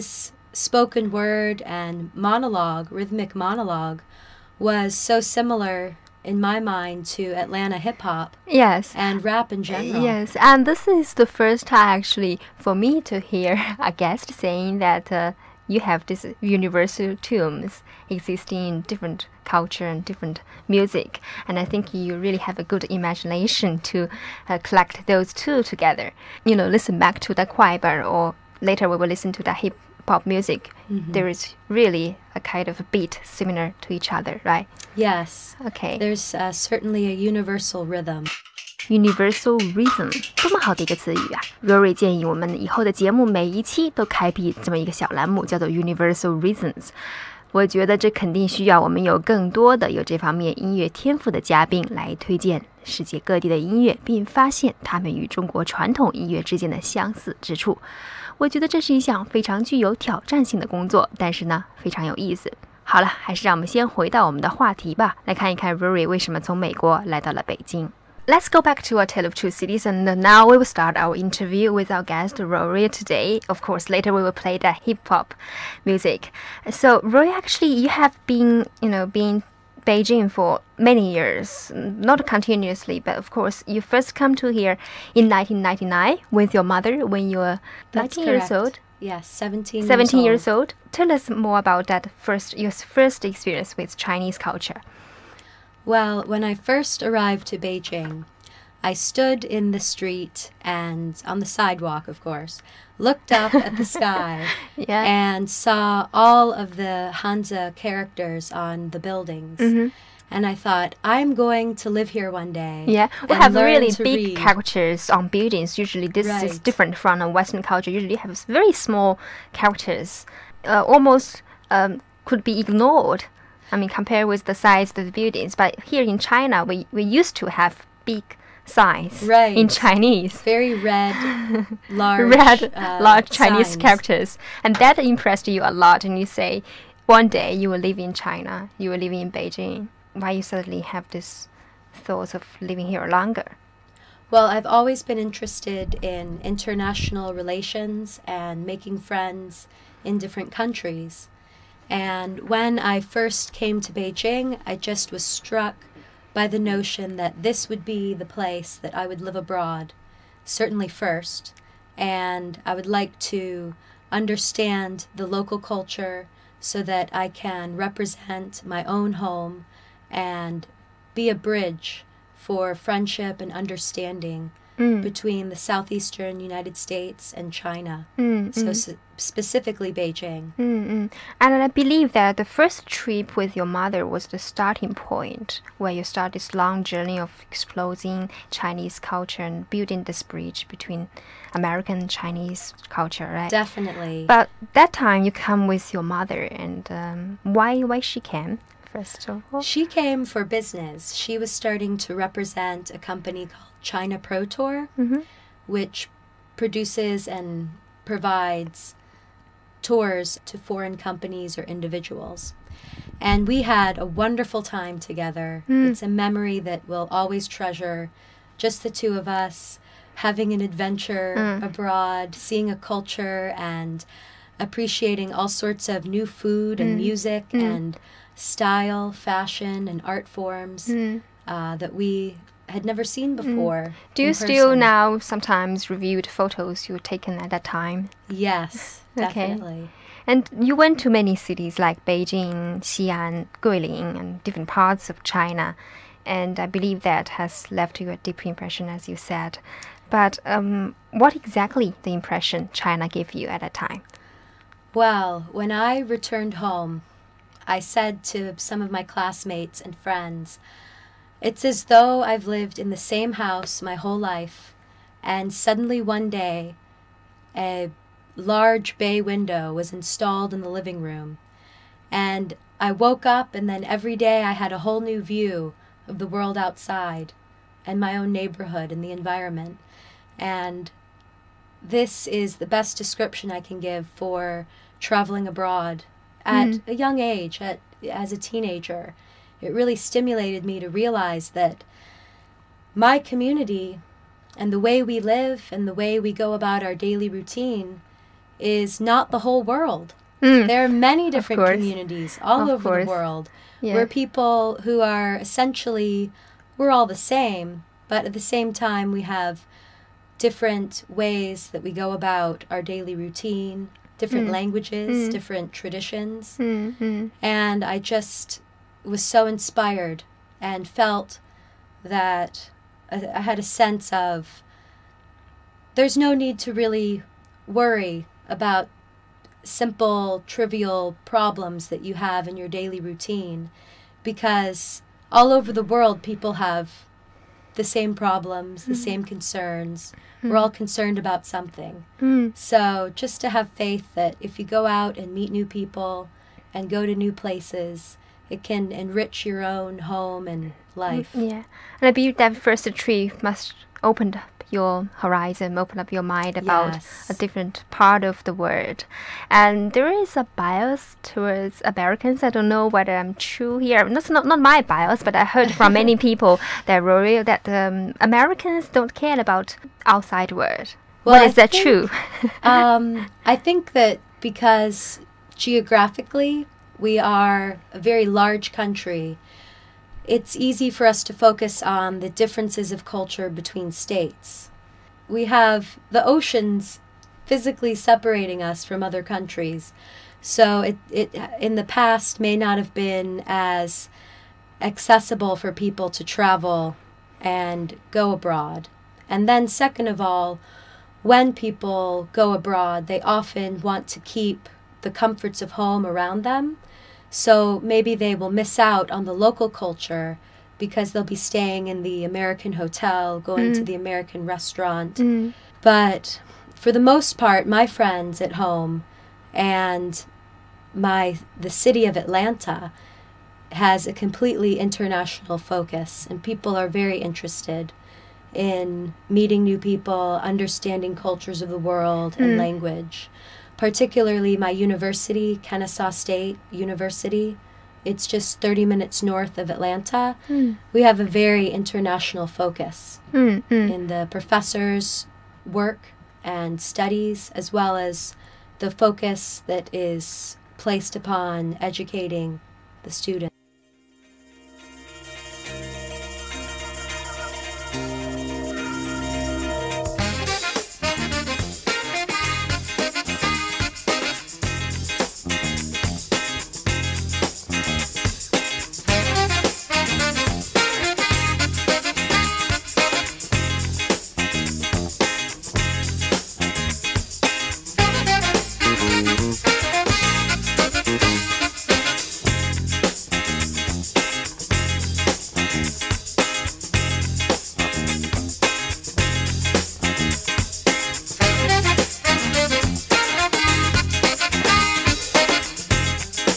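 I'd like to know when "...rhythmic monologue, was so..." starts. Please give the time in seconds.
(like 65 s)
2 s.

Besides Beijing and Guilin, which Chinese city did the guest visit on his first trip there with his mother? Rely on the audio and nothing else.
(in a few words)
Xi'an.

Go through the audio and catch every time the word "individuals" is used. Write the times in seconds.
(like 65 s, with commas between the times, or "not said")
211 s.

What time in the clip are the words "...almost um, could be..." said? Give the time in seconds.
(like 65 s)
120 s.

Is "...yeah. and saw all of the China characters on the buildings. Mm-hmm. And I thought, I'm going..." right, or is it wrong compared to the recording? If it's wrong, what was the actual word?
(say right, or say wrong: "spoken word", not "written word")
wrong: "Hanzi", not "China".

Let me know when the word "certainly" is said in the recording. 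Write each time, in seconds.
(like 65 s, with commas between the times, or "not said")
36 s, 160 s.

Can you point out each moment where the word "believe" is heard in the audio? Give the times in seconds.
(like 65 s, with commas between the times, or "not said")
181 s, 246 s, 352 s.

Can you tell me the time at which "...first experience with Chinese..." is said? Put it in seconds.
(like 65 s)
92 s.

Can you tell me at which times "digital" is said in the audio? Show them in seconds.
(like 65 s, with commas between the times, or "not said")
not said.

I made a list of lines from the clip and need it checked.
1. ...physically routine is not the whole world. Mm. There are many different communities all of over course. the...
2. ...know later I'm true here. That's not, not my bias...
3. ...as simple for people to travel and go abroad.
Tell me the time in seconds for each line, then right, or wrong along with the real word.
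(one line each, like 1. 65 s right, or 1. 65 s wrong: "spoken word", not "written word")
1. 296 s wrong: "daily", not "physically"
2. 362 s wrong: "whether", not "later"
3. 393 s wrong: "accessible", not "simple".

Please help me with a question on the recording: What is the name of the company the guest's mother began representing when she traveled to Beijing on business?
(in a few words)
China Pro Tour.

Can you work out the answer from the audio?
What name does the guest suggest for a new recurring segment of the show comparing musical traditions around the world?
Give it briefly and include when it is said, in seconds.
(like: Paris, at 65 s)
Universal Reasons, at 45 s.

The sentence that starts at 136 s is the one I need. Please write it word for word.
And you say, one day you will live in China, you will live in Beijing.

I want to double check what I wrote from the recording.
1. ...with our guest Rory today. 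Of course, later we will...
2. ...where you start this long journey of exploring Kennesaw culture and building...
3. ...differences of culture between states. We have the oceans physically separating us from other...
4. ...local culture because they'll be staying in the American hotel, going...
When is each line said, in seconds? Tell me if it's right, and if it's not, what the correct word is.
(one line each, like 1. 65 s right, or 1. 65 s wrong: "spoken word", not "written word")
1. 71 s right
2. 185 s wrong: "Chinese", not "Kennesaw"
3. 382 s right
4. 409 s right.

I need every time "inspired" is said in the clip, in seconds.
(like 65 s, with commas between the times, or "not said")
319 s.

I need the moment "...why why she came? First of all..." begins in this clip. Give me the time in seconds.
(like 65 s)
197 s.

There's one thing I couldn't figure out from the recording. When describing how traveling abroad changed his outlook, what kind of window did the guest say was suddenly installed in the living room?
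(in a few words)
a large bay window.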